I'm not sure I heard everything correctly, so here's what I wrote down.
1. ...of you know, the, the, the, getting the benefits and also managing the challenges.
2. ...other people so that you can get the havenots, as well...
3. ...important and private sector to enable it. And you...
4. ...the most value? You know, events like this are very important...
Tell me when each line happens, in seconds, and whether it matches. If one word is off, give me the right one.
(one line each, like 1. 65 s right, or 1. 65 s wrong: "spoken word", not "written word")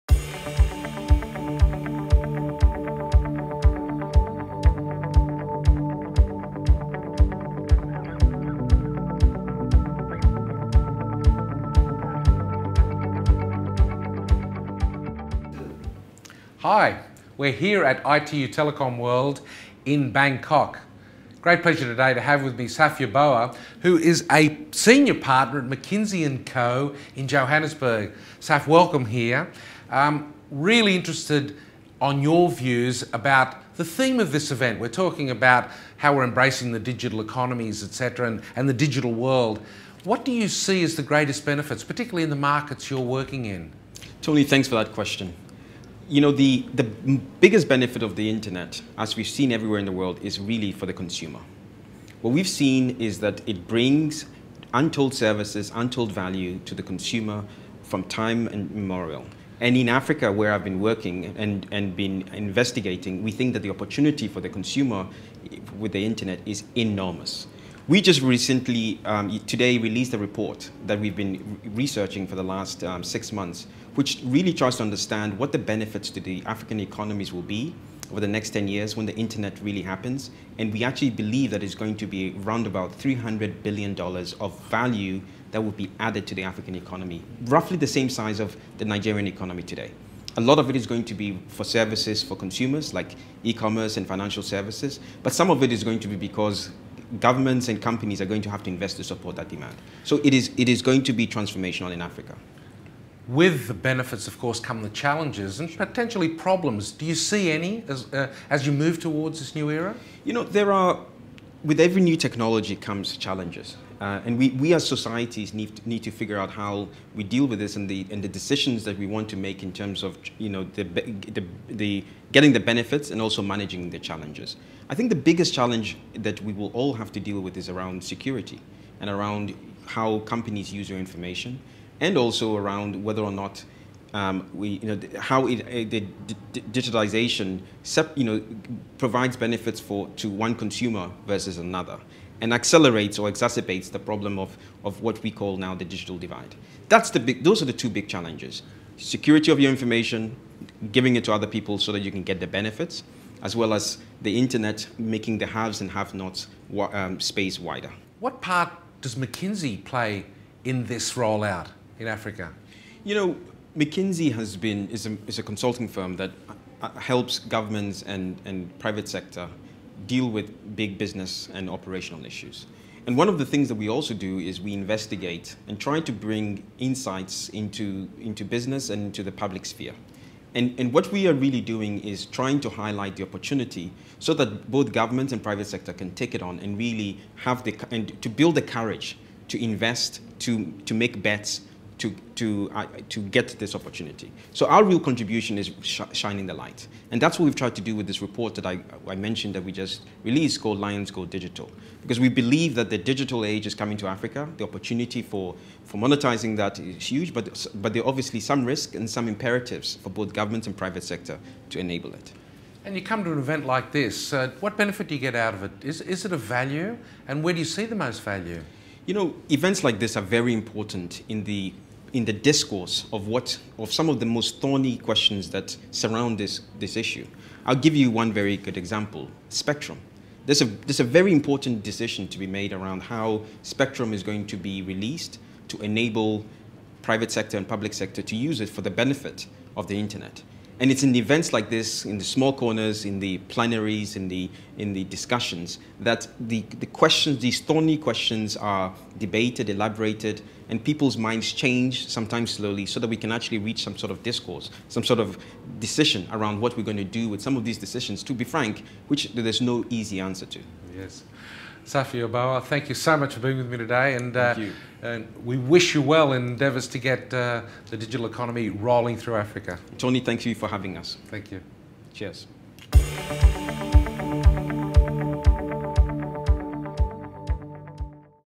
1. 120 s right
2. 151 s wrong: "benefits", not "havenots"
3. 210 s wrong: "government", not "important"
4. 217 s right.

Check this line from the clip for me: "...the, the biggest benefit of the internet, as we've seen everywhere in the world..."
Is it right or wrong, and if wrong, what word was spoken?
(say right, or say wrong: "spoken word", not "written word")
right.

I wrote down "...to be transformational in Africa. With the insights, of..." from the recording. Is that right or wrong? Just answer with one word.
wrong.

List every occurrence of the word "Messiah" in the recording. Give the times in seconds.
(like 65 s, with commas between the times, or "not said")
not said.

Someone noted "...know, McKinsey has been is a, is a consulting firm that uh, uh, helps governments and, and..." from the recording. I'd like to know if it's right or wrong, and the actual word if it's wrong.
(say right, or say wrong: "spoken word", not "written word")
right.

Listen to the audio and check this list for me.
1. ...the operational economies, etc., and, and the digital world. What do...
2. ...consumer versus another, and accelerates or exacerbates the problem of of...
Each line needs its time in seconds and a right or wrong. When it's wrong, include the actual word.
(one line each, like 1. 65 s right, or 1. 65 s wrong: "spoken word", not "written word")
1. 36 s wrong: "digital", not "operational"
2. 140 s right.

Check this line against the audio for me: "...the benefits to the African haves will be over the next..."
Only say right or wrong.
wrong.